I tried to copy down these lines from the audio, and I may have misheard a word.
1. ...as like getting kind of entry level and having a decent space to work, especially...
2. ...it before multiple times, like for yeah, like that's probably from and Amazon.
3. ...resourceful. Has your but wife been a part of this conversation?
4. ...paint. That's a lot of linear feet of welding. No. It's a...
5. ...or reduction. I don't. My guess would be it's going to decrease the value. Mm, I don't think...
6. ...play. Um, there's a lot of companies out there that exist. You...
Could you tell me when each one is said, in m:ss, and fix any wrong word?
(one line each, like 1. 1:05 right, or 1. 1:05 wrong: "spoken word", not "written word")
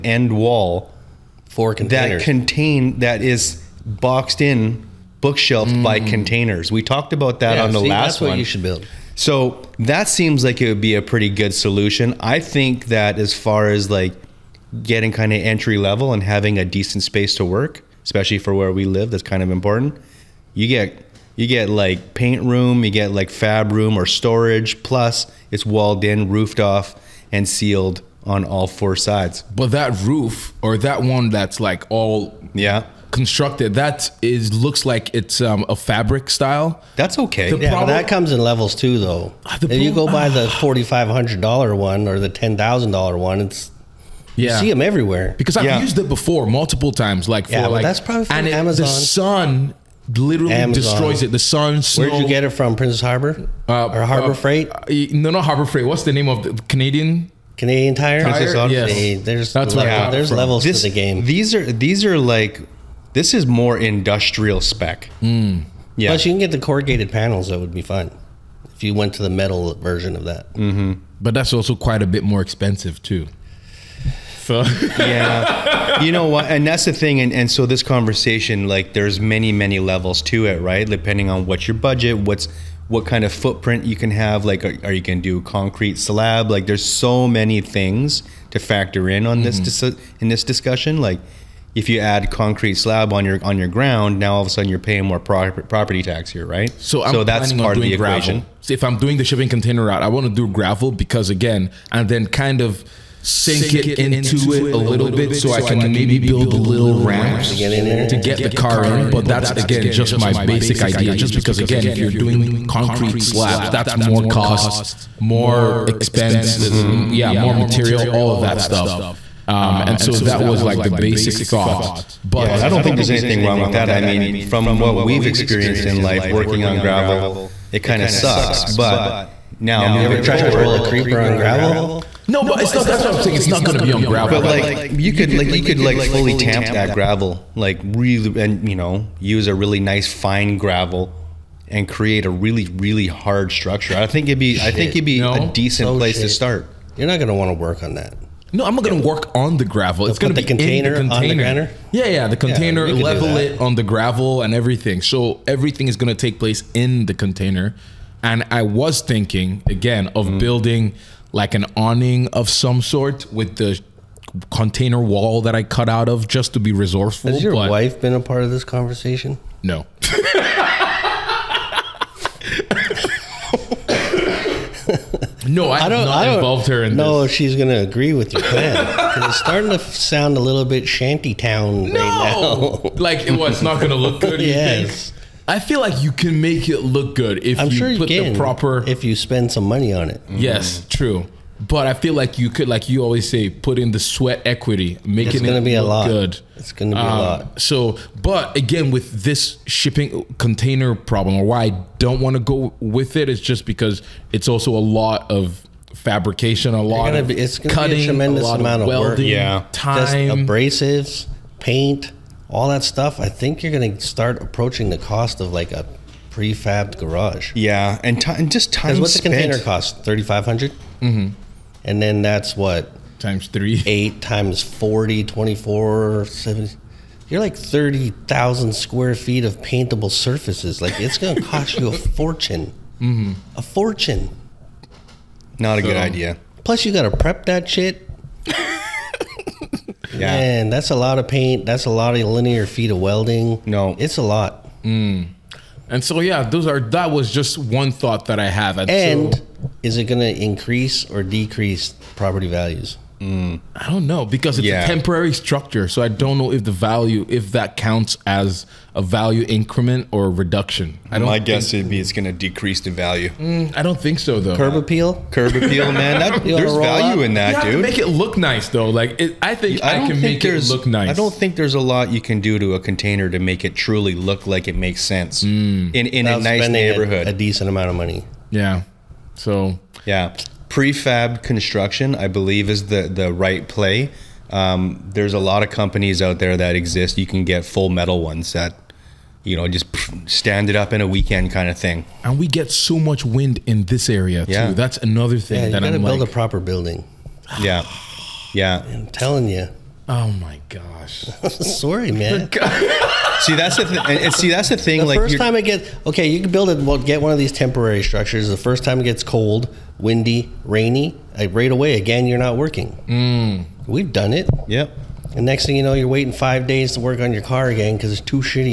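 1. 0:13 right
2. 0:45 right
3. 2:46 right
4. 4:01 right
5. 4:20 right
6. 4:43 right.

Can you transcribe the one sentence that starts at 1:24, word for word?
Like, are, are you going to do concrete slab?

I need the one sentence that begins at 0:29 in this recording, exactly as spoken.
But that roof or that one that's like all yeah constructed that is looks like it's um, a fabric style.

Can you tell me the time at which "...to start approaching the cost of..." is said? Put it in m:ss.
3:33.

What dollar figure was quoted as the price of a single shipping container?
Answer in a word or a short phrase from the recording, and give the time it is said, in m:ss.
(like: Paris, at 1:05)
3500, at 3:40.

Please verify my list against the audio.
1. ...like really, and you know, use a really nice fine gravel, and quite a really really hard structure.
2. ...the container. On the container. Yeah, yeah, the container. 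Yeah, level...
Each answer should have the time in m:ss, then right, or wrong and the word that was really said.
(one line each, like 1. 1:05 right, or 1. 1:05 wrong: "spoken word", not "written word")
1. 2:17 wrong: "create", not "quite"
2. 2:31 right.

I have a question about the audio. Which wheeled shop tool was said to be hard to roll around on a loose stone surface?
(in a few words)
A creeper.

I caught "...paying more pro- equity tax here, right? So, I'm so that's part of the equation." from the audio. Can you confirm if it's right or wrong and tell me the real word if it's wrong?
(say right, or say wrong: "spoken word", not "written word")
wrong: "property", not "equity".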